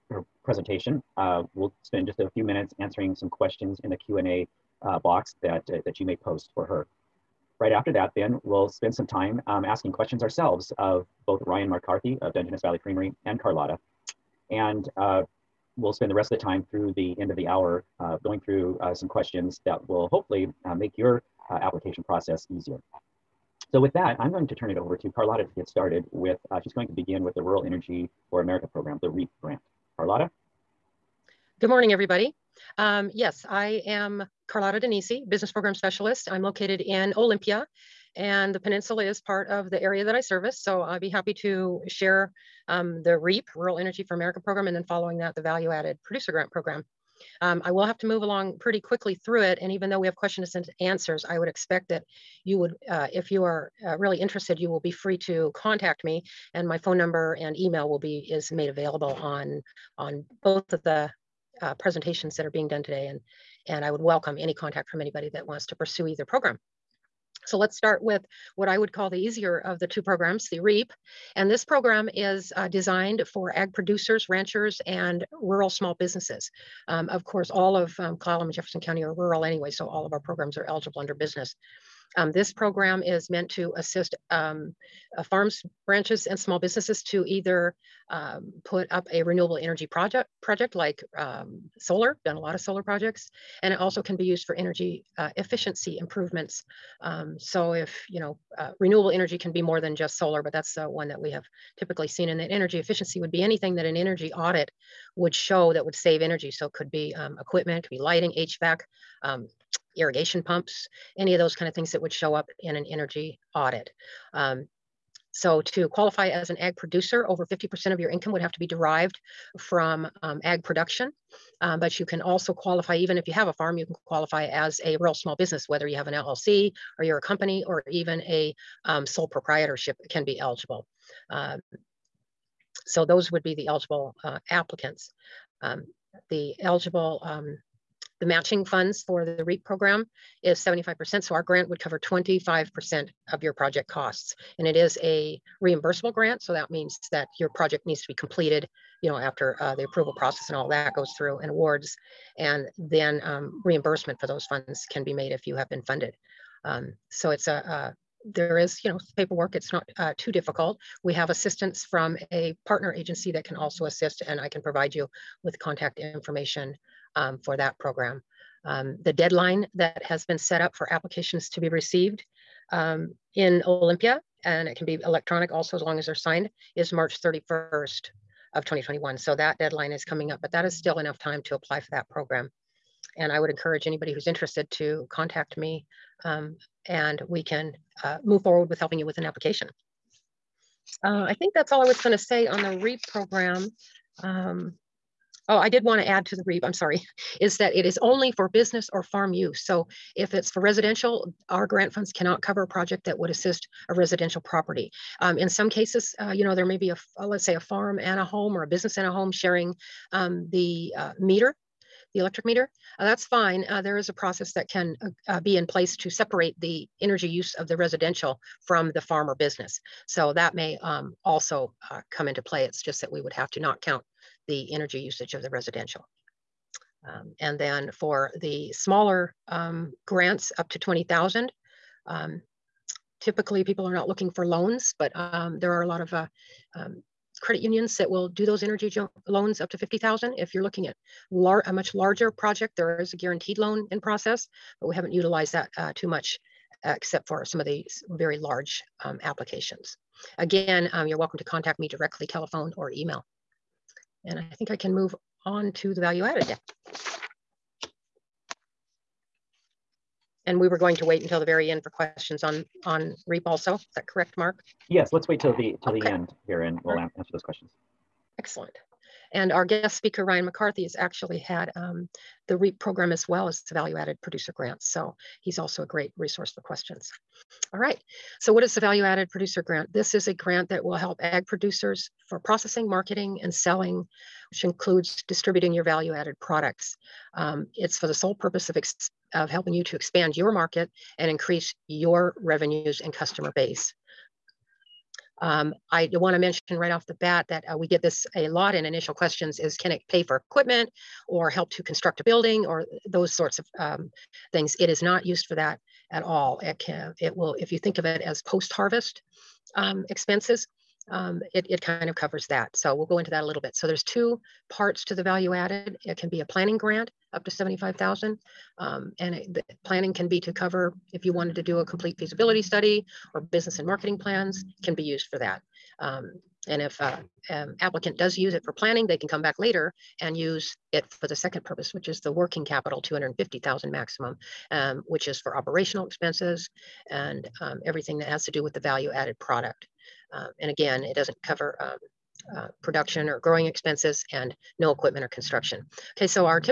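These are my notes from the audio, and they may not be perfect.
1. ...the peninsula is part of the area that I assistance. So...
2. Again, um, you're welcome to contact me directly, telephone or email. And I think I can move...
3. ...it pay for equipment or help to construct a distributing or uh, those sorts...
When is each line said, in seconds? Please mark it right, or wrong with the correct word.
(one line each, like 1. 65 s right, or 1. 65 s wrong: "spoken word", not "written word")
1. 38 s wrong: "service", not "assistance"
2. 250 s right
3. 299 s wrong: "building", not "distributing".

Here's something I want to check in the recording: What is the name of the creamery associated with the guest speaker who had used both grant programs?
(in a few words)
Dungeness Valley Creamery.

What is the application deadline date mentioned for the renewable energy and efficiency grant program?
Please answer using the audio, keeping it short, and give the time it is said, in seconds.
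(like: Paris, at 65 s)
March 31st, 2021, at 176 s.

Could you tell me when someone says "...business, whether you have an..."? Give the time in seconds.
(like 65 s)
125 s.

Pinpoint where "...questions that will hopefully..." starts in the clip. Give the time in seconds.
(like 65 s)
19 s.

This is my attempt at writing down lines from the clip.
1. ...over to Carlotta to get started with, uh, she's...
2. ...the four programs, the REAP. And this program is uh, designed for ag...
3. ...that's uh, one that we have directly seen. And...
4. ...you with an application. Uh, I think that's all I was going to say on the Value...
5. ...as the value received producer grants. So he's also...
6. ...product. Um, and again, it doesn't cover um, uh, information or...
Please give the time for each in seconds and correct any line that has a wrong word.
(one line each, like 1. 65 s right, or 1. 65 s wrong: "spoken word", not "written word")
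1. 24 s right
2. 69 s wrong: "two", not "four"
3. 100 s wrong: "typically", not "directly"
4. 188 s wrong: "REAP", not "Value"
5. 273 s wrong: "added", not "received"
6. 339 s wrong: "production", not "information".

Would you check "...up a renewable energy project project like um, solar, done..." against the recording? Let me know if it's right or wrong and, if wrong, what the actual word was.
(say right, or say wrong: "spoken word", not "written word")
right.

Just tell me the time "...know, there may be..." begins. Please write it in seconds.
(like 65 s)
206 s.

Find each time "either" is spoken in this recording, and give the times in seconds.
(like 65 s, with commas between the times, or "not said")
66 s, 87 s.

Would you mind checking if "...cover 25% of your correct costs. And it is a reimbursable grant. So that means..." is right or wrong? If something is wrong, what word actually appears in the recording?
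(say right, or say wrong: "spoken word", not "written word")
wrong: "project", not "correct".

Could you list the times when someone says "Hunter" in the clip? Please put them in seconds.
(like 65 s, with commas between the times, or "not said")
not said.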